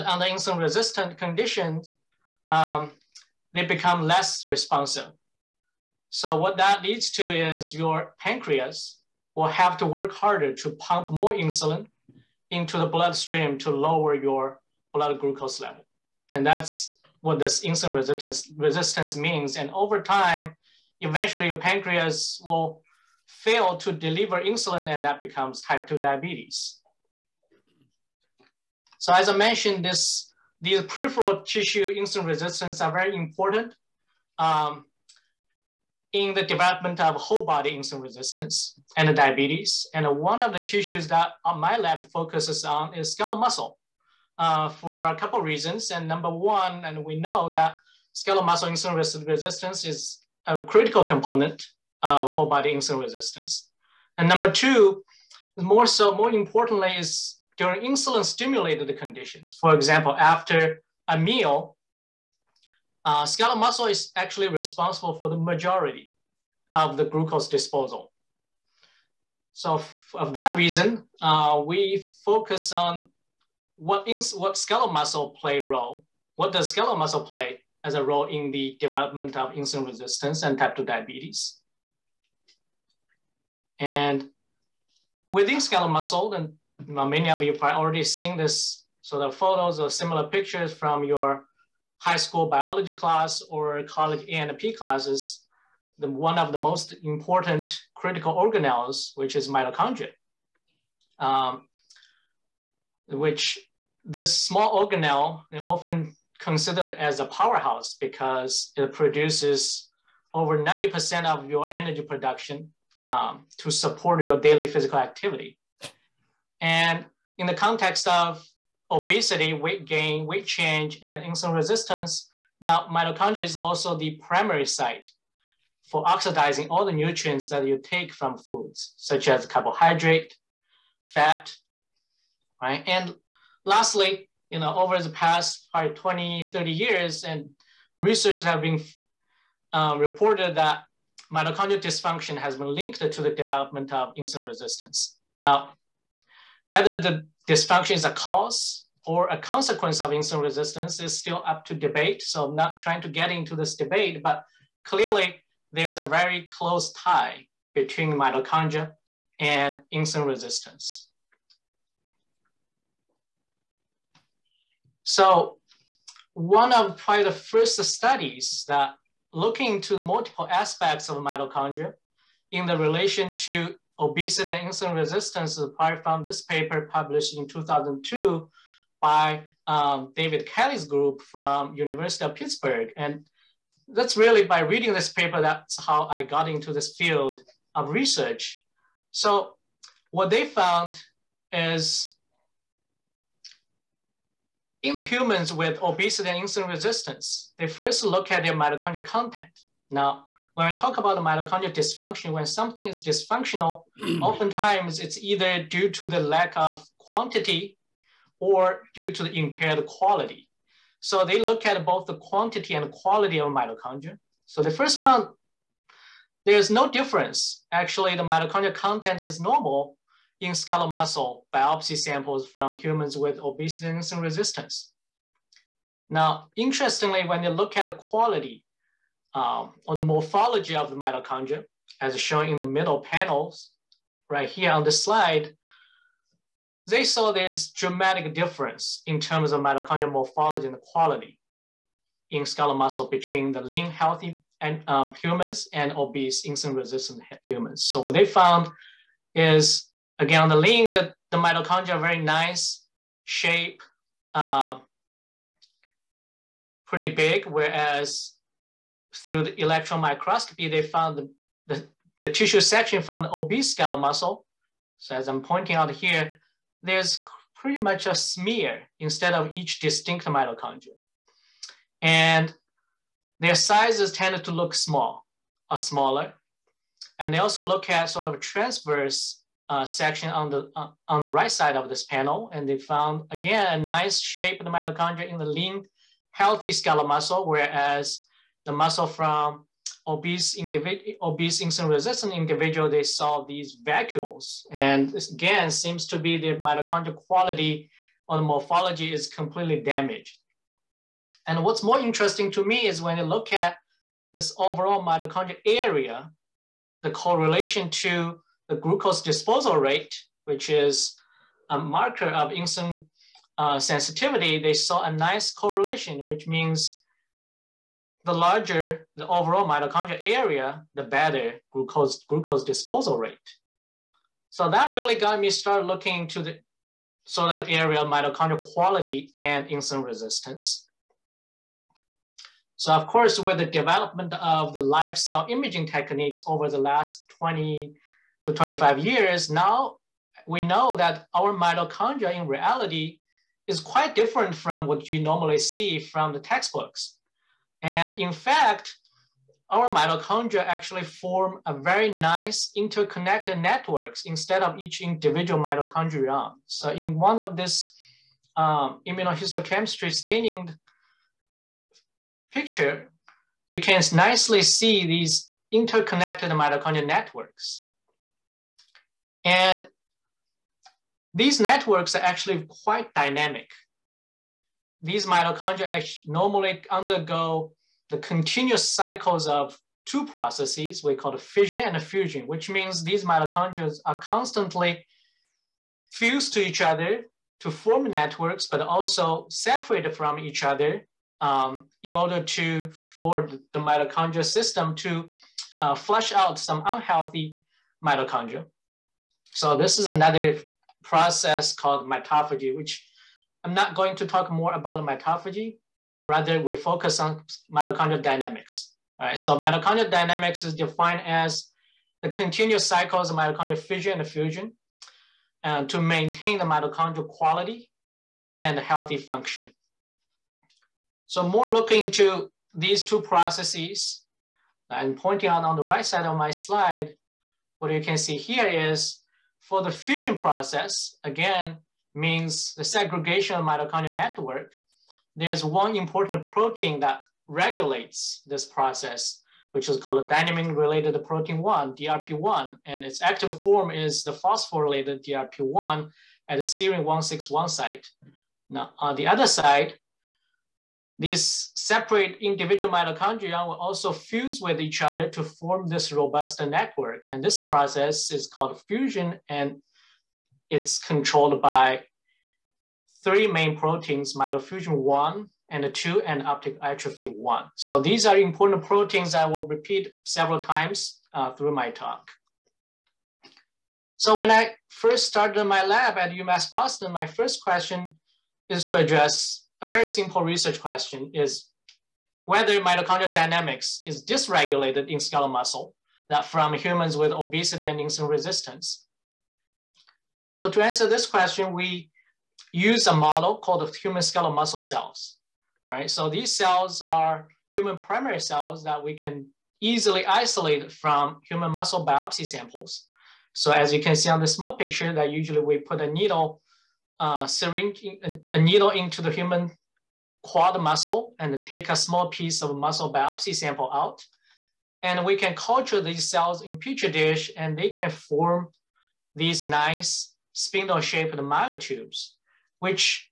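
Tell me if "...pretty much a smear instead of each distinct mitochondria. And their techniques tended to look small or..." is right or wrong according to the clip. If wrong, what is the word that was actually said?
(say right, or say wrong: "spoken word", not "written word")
wrong: "sizes", not "techniques".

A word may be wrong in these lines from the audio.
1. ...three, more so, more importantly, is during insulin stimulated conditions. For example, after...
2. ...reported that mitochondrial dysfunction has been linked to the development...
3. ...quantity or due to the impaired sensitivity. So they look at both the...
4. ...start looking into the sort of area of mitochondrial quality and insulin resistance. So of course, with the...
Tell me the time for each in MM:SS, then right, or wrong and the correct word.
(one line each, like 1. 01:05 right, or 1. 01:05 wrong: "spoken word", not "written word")
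1. 00:54 wrong: "two", not "three"
2. 02:19 right
3. 03:26 wrong: "quality", not "sensitivity"
4. 05:25 right.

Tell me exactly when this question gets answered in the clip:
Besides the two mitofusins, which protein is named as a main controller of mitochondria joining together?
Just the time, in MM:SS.
07:46.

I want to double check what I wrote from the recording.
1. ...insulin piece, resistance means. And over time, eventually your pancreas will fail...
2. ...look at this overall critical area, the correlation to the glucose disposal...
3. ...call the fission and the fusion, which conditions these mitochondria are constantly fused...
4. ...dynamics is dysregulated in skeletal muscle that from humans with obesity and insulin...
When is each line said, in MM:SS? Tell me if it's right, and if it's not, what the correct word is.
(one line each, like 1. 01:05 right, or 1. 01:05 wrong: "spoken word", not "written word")
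1. 00:17 wrong: "resistance", not "piece"
2. 05:03 wrong: "mitochondrial", not "critical"
3. 06:21 wrong: "means", not "conditions"
4. 08:03 right.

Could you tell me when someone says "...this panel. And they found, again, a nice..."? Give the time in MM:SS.
04:41.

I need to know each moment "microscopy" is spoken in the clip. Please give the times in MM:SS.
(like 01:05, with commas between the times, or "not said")
04:20.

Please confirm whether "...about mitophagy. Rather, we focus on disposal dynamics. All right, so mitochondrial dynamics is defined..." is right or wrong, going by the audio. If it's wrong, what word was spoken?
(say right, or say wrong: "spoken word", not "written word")
wrong: "mitochondrial", not "disposal".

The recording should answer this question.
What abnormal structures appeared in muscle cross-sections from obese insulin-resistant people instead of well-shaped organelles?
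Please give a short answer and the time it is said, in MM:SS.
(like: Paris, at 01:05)
vacuoles, at 04:53.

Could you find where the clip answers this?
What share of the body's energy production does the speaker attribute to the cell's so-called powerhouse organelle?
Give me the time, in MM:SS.
01:50.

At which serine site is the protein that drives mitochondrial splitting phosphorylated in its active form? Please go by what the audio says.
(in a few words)
serine 161.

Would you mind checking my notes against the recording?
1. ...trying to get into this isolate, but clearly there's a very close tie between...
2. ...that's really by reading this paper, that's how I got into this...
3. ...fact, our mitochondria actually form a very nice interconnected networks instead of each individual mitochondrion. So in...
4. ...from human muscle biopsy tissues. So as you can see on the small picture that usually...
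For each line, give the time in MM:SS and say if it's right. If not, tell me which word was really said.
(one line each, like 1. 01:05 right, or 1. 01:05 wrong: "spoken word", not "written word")
1. 02:32 wrong: "debate", not "isolate"
2. 03:03 right
3. 05:48 right
4. 08:20 wrong: "samples", not "tissues".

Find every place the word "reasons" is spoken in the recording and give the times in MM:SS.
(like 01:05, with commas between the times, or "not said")
00:45, 01:10.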